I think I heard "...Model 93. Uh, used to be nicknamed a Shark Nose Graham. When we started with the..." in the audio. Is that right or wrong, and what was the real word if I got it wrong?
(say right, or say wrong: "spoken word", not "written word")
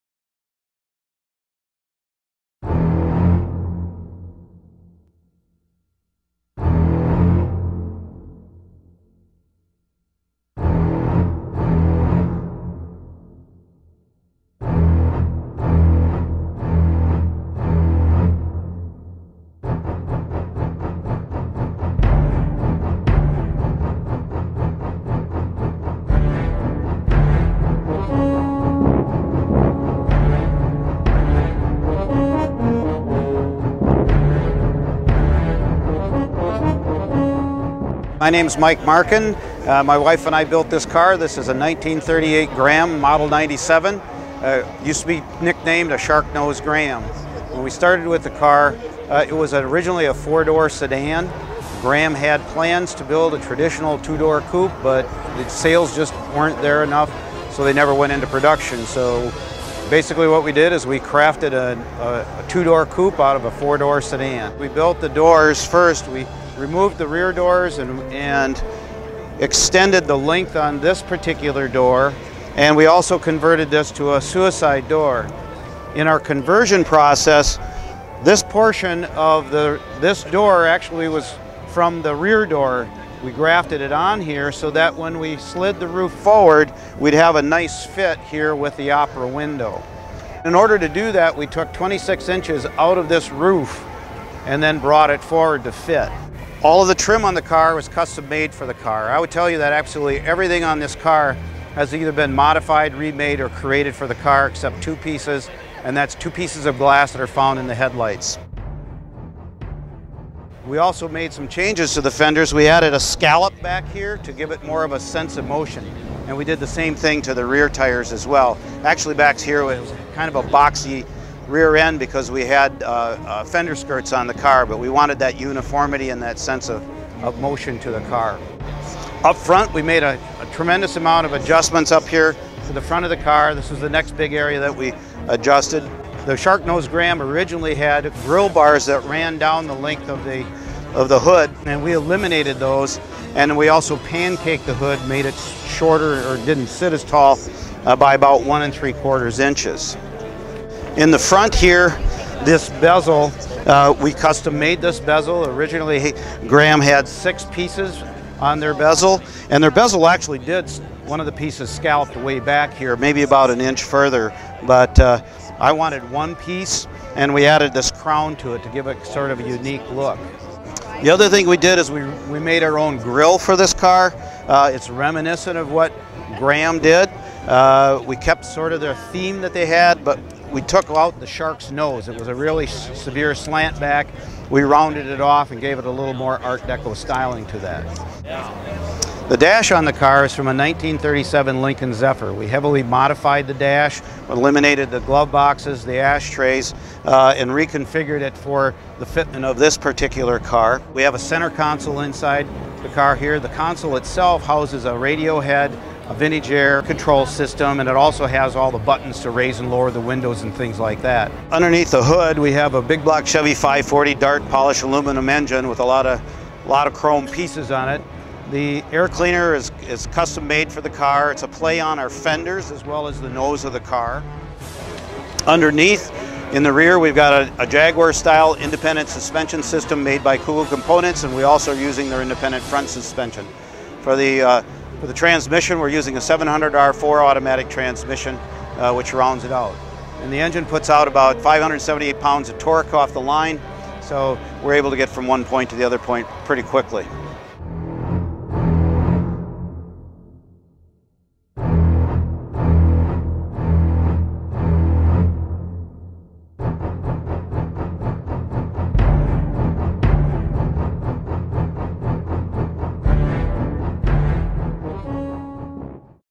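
wrong: "97", not "93".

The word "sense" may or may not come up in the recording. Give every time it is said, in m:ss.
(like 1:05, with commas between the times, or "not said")
1:54, 2:06.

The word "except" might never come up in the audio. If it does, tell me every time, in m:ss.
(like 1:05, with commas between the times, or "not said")
1:44.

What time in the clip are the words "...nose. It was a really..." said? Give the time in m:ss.
3:01.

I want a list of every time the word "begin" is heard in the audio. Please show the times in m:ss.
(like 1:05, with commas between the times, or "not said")
not said.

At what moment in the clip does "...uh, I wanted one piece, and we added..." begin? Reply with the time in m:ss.
2:44.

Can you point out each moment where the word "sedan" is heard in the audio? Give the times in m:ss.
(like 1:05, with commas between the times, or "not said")
0:50, 1:03.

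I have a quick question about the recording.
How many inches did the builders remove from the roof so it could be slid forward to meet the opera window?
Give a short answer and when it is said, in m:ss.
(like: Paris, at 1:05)
26, at 1:31.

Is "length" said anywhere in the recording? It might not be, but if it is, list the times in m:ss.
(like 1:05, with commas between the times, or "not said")
1:10, 2:19.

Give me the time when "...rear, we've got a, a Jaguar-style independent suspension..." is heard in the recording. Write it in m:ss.
3:46.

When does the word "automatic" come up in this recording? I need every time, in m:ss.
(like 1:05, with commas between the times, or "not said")
3:57.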